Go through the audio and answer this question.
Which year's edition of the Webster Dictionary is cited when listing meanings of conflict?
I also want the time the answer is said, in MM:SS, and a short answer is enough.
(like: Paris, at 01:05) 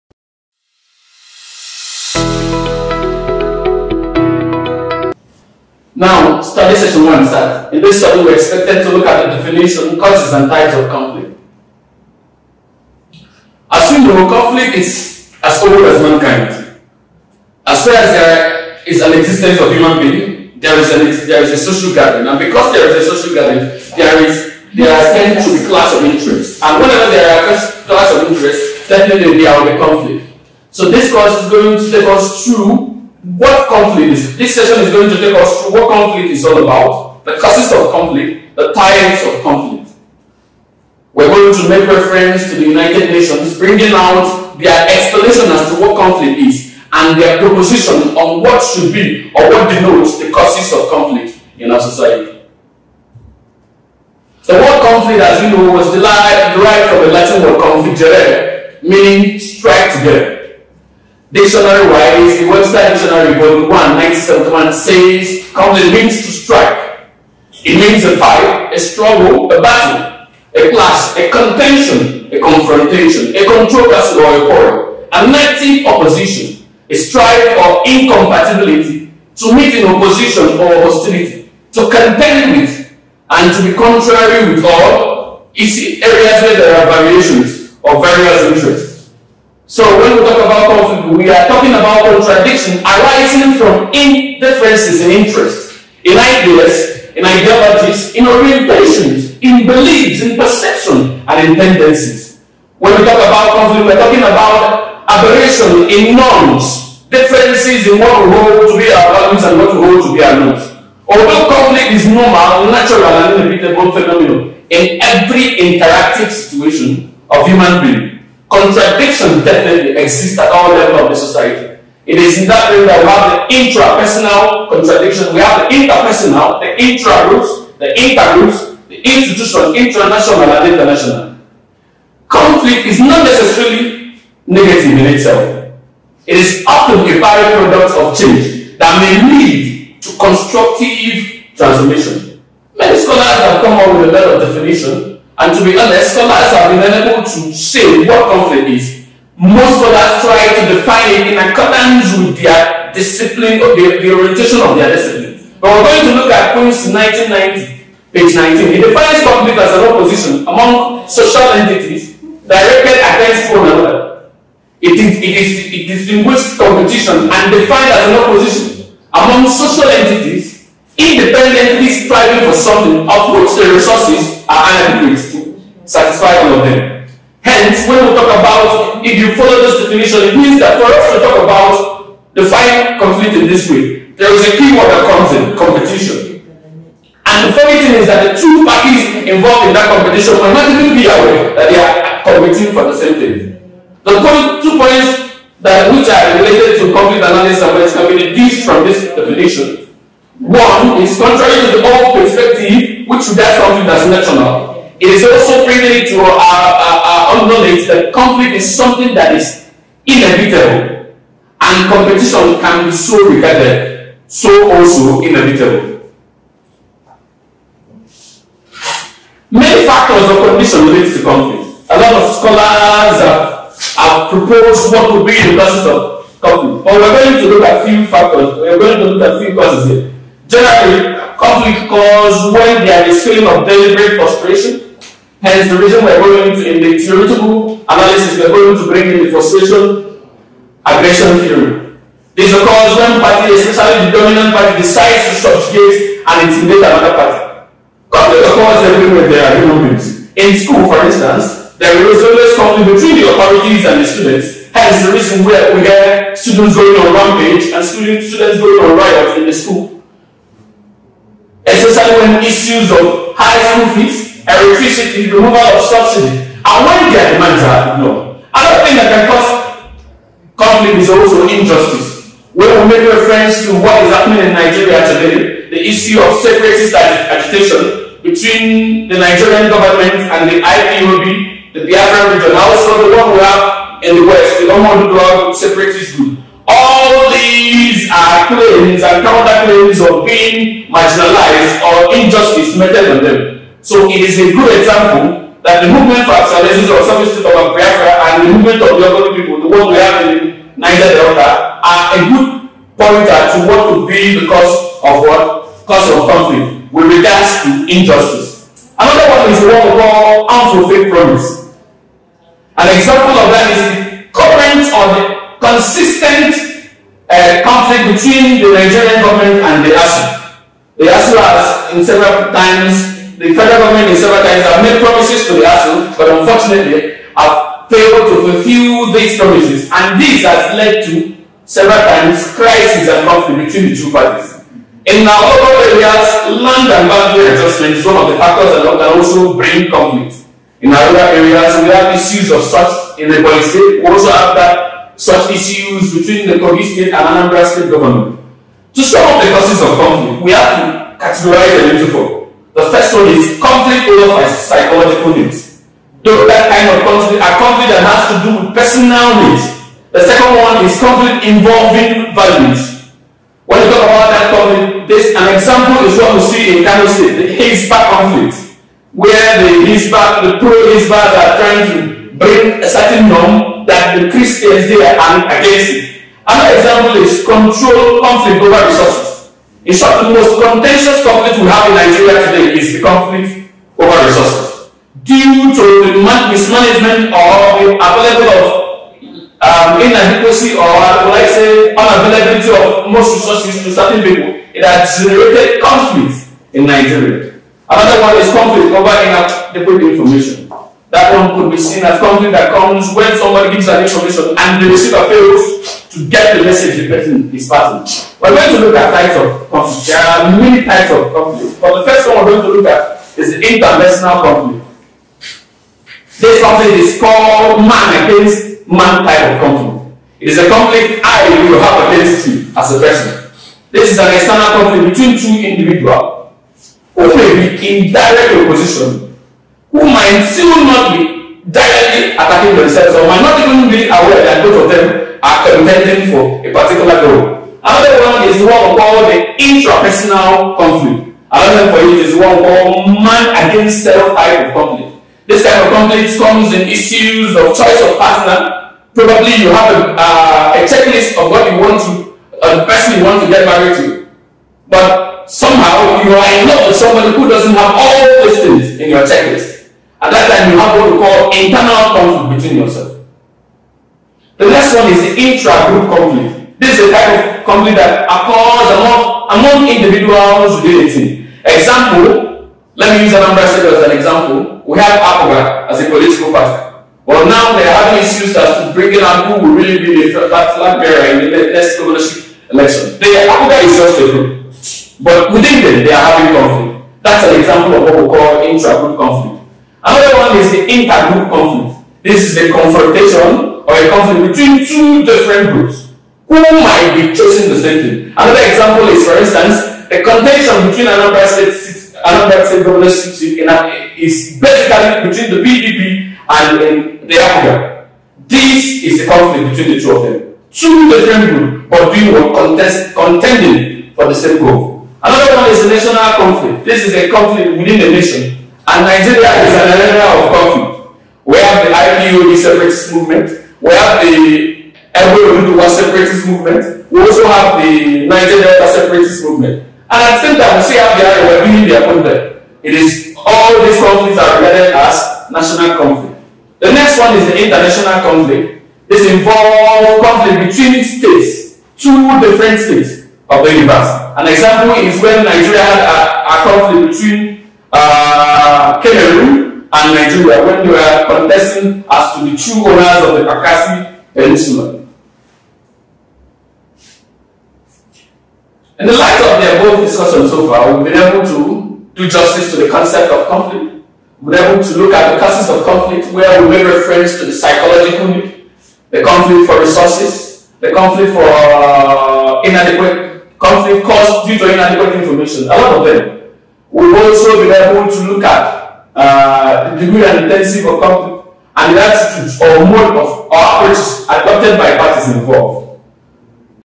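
1971, at 01:03.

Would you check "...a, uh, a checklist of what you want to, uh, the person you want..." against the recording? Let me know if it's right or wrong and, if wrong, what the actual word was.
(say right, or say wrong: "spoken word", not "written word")
right.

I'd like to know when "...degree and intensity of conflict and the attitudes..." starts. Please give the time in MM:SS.
09:40.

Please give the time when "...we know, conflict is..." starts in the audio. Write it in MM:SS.
00:13.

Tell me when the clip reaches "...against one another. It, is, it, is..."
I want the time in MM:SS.
02:43.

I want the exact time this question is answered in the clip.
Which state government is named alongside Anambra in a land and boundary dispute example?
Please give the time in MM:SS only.
05:46.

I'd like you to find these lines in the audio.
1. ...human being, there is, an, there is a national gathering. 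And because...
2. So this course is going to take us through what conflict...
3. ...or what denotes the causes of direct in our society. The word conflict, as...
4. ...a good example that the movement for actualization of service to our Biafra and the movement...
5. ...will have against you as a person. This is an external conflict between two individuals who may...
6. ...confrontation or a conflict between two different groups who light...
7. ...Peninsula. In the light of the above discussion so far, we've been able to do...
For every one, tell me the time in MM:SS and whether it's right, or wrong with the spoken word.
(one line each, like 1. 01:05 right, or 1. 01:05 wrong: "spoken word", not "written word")
1. 00:19 wrong: "social", not "national"
2. 00:30 right
3. 00:49 wrong: "conflict", not "direct"
4. 04:54 right
5. 07:01 right
6. 08:12 wrong: "might", not "light"
7. 09:14 right.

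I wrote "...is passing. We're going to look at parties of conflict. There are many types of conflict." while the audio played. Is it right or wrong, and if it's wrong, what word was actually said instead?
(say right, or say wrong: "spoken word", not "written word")
wrong: "types", not "parties".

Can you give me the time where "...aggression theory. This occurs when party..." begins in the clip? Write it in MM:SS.
04:00.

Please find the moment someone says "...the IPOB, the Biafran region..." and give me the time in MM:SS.
04:40.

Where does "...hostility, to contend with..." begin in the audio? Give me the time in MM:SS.
01:20.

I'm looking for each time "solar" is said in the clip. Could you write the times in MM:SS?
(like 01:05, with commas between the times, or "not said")
not said.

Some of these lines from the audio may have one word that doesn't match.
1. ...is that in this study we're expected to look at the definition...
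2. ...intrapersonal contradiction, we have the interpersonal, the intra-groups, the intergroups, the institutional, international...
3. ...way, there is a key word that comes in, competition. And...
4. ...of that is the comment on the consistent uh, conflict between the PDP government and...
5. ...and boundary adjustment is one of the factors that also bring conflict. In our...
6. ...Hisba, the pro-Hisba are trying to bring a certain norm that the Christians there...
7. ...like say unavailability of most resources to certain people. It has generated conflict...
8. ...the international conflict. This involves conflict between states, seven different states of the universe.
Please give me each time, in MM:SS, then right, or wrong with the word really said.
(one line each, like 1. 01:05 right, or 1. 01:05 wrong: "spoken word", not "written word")
1. 00:07 right
2. 02:03 right
3. 03:03 right
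4. 05:13 wrong: "Nigerian", not "PDP"
5. 05:36 right
6. 06:09 right
7. 06:31 right
8. 08:57 wrong: "two", not "seven".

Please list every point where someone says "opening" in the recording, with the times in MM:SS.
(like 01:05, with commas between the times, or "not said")
not said.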